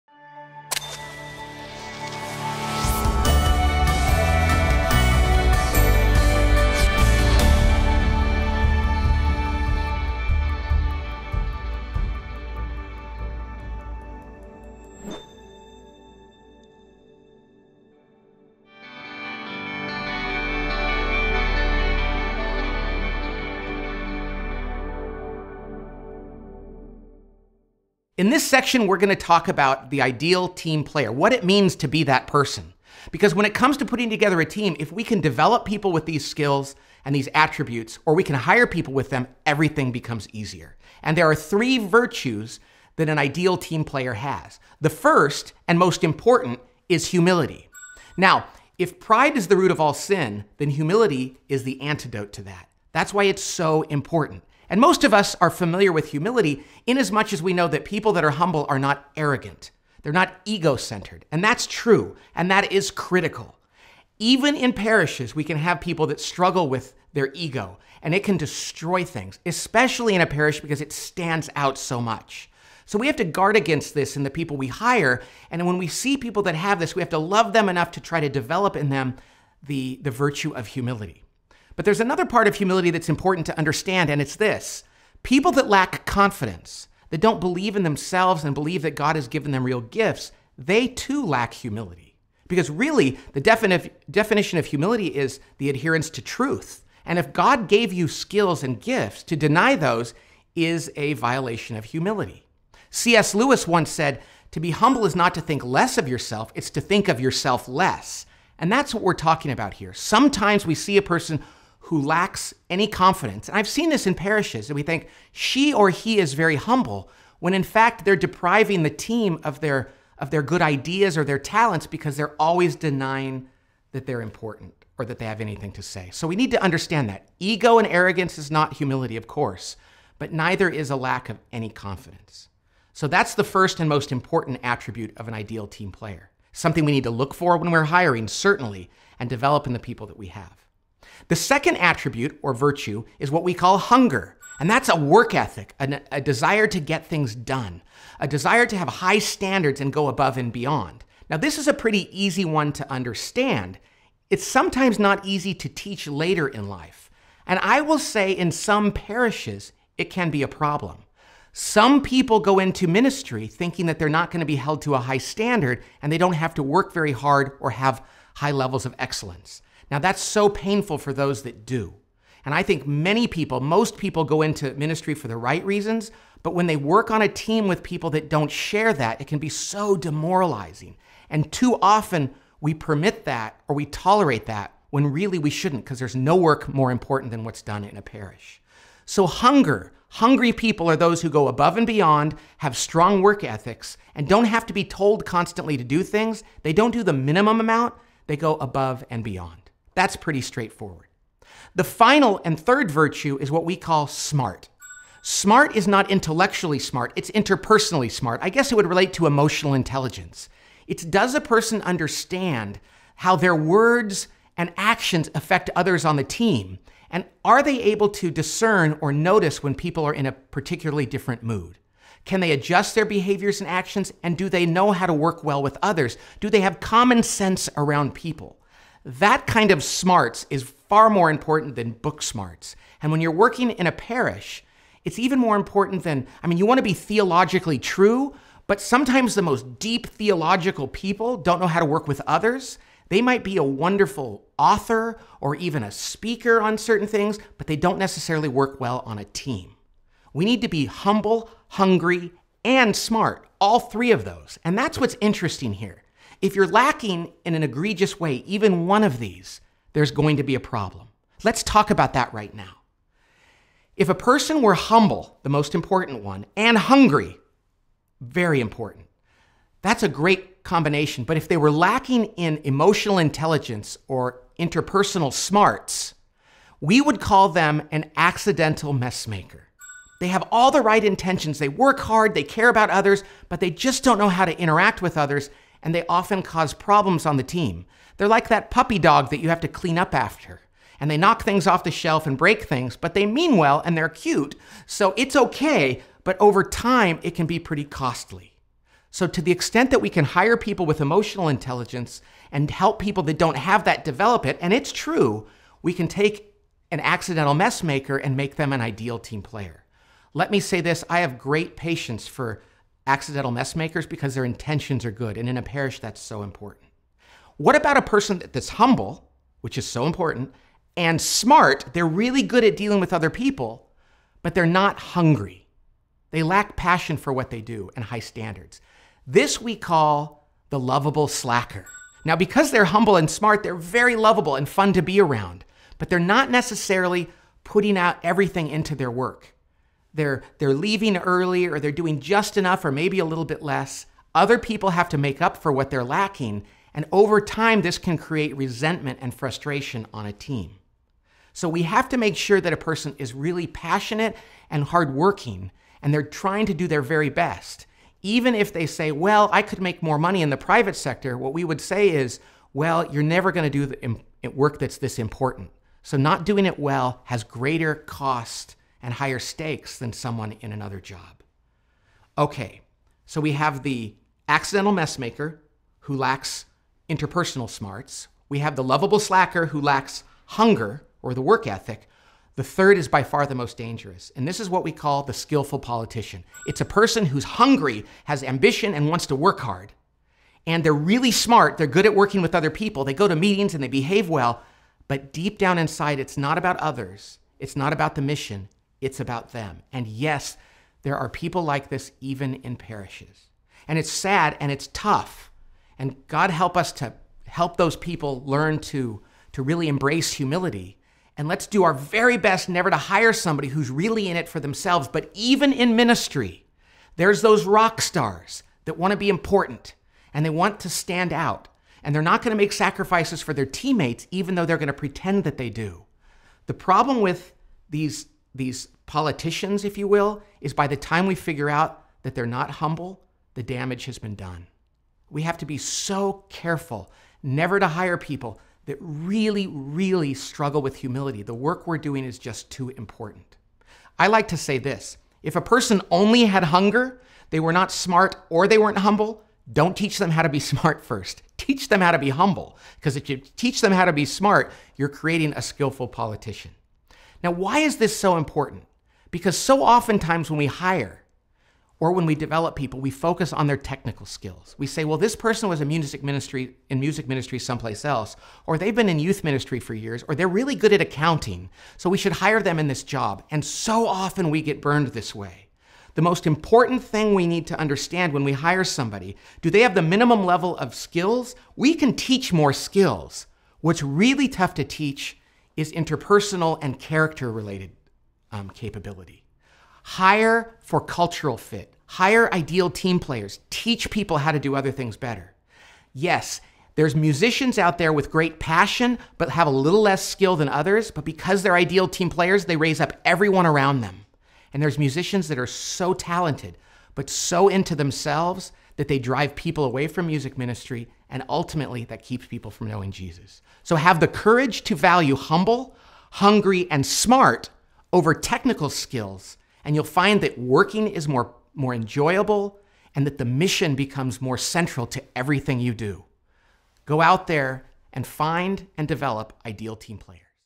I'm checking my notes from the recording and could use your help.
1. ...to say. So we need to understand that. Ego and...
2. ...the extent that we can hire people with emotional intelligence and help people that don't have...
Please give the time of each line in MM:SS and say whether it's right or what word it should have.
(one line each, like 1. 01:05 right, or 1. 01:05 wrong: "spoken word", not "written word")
1. 02:05 right
2. 04:59 right.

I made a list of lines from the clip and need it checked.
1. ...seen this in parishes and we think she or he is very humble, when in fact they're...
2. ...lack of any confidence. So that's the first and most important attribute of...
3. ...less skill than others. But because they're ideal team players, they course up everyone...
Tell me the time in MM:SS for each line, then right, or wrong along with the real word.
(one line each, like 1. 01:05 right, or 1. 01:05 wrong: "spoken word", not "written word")
1. 01:53 right
2. 02:10 right
3. 08:20 wrong: "raise", not "course".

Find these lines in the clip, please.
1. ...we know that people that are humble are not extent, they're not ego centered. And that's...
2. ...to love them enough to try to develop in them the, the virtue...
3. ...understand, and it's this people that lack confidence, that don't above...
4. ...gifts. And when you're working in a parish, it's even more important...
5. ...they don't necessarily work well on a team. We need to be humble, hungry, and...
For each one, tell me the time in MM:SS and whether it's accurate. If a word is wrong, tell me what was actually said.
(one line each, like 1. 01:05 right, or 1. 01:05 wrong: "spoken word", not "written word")
1. 00:57 wrong: "arrogant", not "extent"
2. 01:17 right
3. 01:23 wrong: "believe", not "above"
4. 03:52 wrong: "smarts", not "gifts"
5. 04:07 right.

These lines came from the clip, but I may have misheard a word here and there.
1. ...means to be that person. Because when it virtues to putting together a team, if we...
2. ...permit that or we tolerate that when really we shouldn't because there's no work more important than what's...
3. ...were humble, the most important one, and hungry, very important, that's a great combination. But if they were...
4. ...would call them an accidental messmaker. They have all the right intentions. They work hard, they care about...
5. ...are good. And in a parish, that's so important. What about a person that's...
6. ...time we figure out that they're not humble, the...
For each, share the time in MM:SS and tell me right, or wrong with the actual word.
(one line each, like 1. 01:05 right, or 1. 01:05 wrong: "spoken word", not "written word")
1. 00:31 wrong: "comes", not "virtues"
2. 03:02 right
3. 04:24 right
4. 04:37 right
5. 05:15 right
6. 07:10 right.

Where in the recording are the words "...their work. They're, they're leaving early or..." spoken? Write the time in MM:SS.
05:38.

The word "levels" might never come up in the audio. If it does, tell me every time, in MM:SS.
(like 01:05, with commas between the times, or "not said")
02:48, 08:00.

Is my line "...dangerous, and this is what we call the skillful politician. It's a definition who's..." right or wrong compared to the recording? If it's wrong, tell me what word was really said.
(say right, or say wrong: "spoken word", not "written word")
wrong: "person", not "definition".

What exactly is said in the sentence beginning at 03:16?
They don't do the minimum amount, they go above and beyond.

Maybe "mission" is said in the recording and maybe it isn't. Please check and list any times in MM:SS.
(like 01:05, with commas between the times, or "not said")
06:38, 08:43.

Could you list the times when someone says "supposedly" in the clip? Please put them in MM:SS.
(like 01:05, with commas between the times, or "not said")
not said.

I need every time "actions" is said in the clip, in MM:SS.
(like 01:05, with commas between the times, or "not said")
03:34, 03:43.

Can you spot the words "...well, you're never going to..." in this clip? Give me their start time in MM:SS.
06:02.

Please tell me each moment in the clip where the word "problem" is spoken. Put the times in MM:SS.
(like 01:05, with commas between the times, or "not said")
02:40, 04:20, 04:46, 07:06.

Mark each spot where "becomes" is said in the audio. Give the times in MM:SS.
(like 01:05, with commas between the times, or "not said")
00:39, 08:43.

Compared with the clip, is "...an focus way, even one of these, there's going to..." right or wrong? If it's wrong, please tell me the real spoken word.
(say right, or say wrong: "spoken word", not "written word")
wrong: "egregious", not "focus".